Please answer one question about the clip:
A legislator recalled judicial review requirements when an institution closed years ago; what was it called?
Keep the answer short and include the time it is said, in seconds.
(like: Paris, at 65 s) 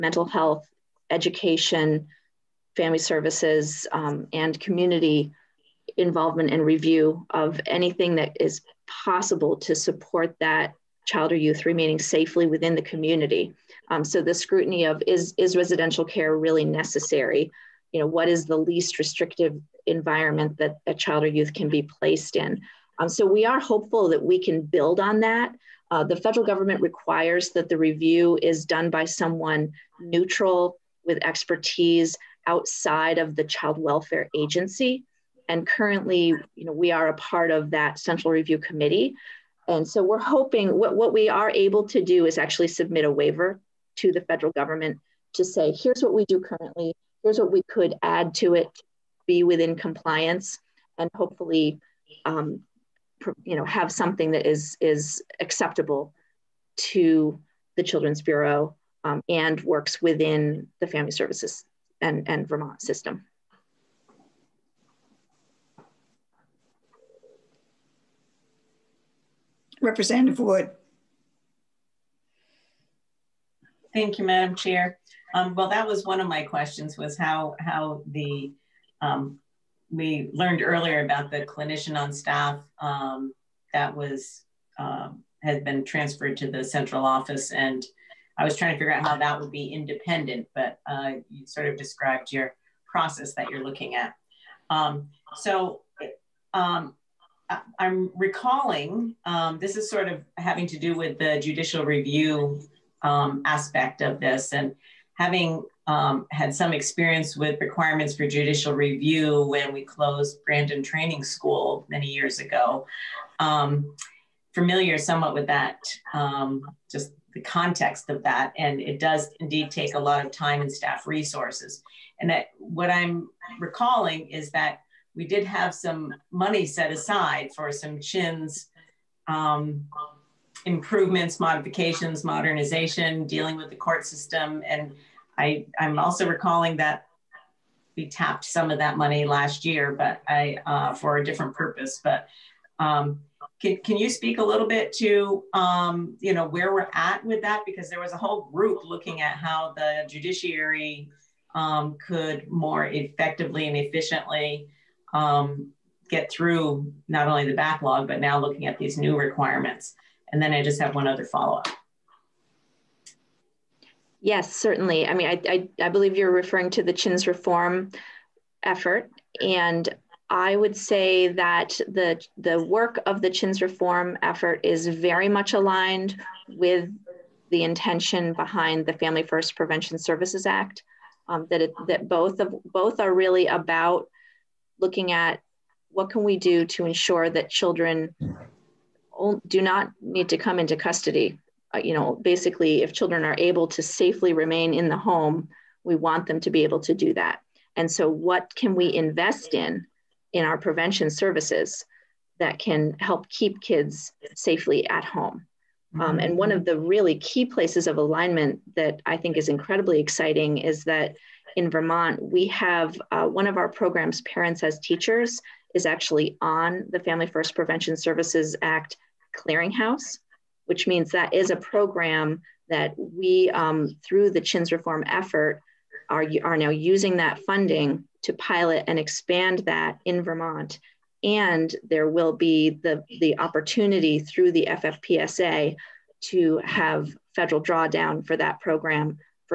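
Brandon Training School, at 110 s.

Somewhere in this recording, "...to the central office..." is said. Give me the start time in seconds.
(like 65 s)
86 s.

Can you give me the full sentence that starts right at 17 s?
you know, what is the least restrictive environment that a child or youth can be placed in.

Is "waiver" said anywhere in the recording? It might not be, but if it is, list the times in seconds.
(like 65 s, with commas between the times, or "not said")
43 s.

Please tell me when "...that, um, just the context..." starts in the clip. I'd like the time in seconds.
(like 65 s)
115 s.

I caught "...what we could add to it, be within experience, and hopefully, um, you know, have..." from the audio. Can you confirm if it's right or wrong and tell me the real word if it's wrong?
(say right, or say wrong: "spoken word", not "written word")
wrong: "compliance", not "experience".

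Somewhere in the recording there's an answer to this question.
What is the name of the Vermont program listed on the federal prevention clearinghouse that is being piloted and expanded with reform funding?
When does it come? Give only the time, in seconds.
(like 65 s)
214 s.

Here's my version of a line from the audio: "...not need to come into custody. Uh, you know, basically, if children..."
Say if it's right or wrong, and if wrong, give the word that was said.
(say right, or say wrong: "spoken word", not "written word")
right.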